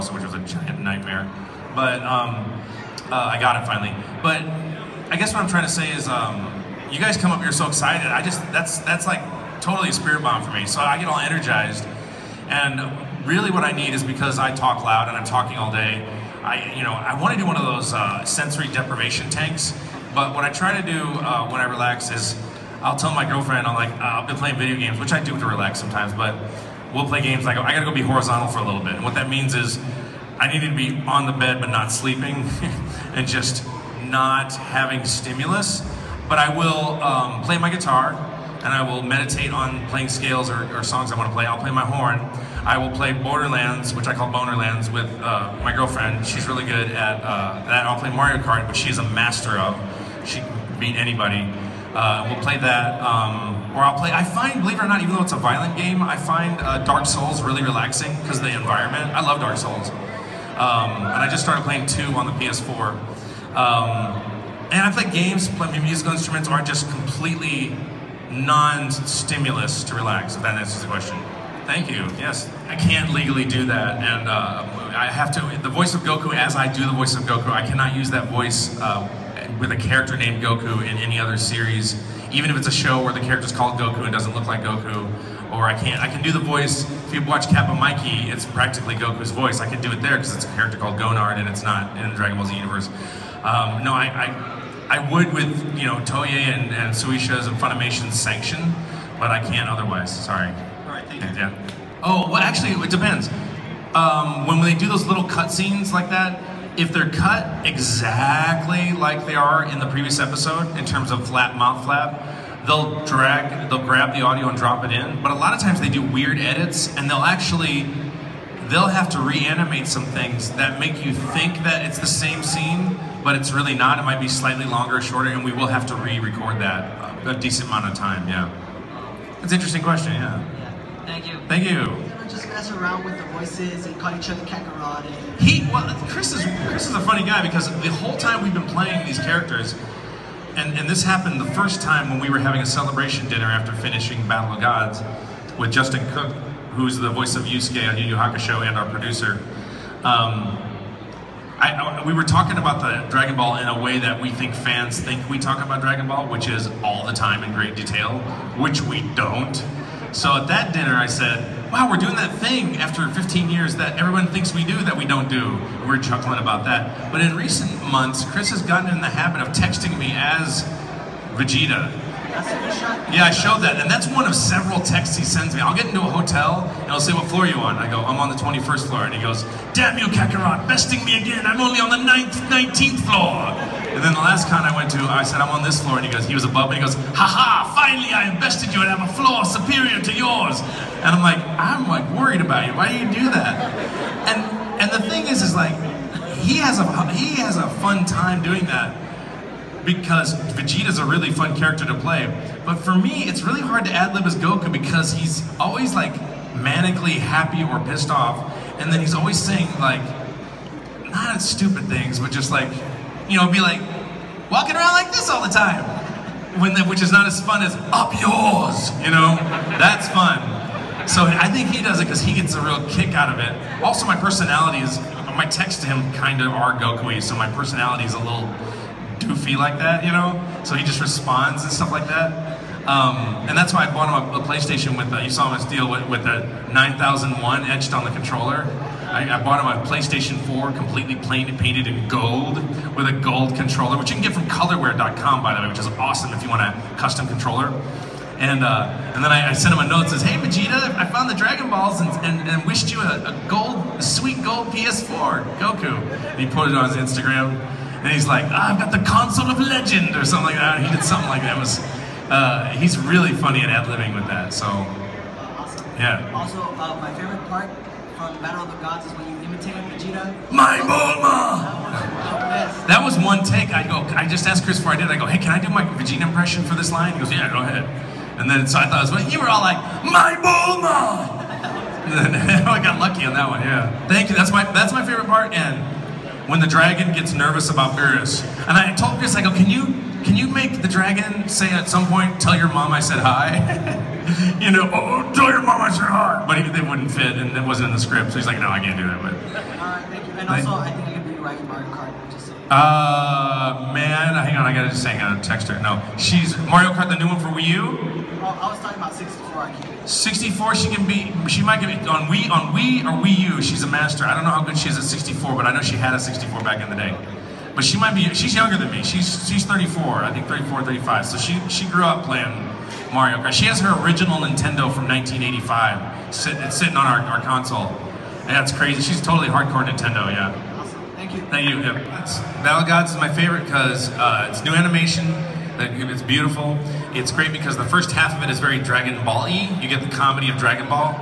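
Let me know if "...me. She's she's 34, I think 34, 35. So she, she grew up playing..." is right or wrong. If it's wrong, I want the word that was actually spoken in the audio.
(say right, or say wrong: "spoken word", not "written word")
right.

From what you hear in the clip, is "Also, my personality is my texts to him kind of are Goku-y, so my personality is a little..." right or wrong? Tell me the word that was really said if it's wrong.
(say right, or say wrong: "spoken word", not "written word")
right.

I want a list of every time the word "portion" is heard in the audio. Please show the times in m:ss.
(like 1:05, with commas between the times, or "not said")
not said.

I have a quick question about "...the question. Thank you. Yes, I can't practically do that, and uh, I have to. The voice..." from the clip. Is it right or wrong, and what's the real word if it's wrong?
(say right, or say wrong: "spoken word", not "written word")
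wrong: "legally", not "practically".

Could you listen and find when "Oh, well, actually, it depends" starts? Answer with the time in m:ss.
1:42.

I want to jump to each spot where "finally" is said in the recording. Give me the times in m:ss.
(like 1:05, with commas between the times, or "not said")
0:03, 3:07.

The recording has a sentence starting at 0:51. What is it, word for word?
Uh, we'll play that, um, or I'll play.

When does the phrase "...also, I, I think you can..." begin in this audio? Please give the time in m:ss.
5:00.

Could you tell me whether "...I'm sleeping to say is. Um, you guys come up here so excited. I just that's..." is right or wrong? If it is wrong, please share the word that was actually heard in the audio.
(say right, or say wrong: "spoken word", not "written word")
wrong: "trying", not "sleeping".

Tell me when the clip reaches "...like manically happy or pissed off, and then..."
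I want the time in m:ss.
3:25.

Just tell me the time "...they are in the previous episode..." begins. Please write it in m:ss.
1:49.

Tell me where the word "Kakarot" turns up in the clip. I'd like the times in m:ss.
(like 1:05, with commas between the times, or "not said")
2:14, 3:00.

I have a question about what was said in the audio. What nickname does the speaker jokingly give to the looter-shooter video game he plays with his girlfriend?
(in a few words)
Bonerlands.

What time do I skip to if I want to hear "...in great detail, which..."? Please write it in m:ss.
2:37.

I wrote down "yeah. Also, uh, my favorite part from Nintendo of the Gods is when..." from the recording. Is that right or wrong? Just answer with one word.
wrong.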